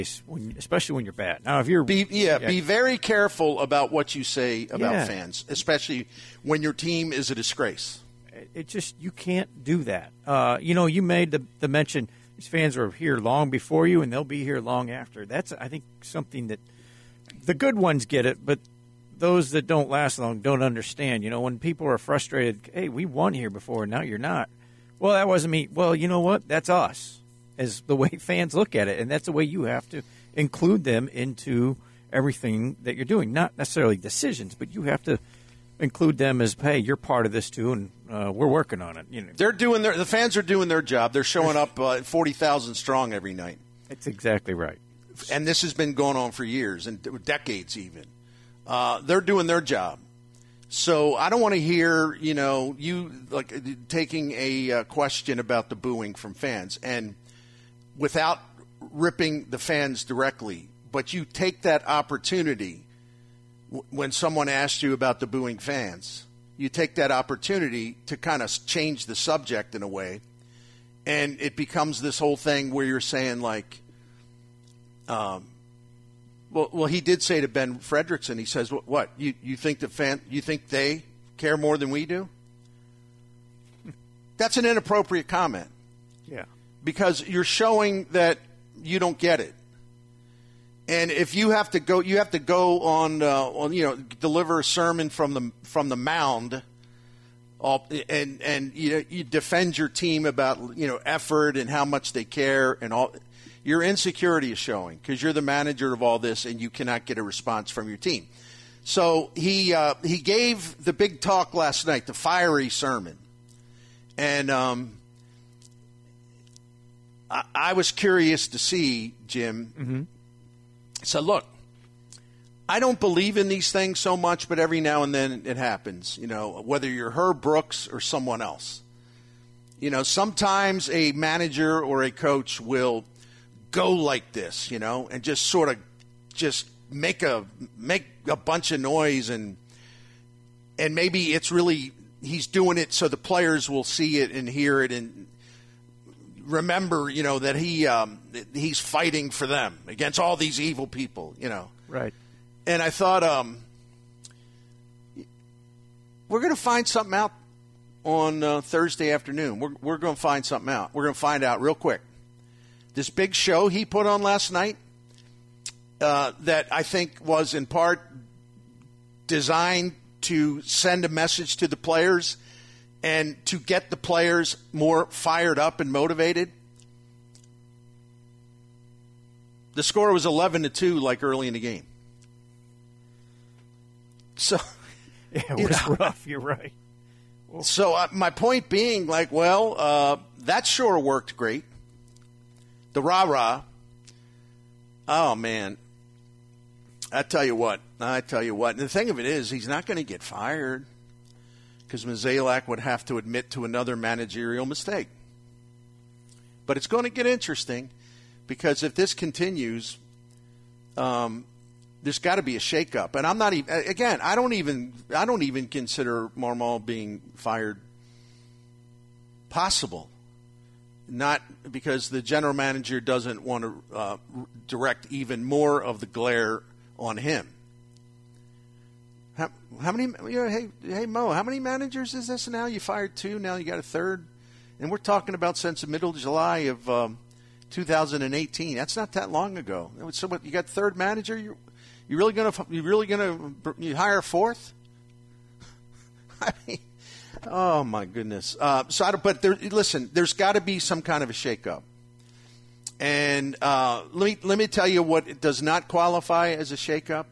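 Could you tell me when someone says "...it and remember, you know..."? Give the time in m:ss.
2:24.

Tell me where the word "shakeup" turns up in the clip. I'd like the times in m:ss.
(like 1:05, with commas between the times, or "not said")
3:32, 4:11, 4:16.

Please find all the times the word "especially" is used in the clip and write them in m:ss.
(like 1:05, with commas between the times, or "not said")
0:00, 0:05.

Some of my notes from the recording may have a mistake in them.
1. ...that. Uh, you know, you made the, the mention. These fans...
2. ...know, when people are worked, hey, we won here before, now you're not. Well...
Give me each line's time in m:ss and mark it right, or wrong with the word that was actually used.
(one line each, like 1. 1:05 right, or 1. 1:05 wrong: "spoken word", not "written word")
1. 0:09 right
2. 0:21 wrong: "frustrated", not "worked".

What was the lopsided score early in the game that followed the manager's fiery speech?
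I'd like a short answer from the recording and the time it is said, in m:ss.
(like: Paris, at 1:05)
11 to 2, at 3:00.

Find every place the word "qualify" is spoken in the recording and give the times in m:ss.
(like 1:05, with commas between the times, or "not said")
4:15.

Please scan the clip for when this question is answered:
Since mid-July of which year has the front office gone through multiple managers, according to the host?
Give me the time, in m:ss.
3:57.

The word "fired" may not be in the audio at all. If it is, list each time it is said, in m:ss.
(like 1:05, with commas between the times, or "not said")
2:55, 3:20, 3:37, 3:52.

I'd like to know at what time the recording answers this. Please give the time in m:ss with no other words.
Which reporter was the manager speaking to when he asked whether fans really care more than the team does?
1:17.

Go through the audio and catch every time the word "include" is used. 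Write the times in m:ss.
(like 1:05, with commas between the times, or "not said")
0:30, 0:35.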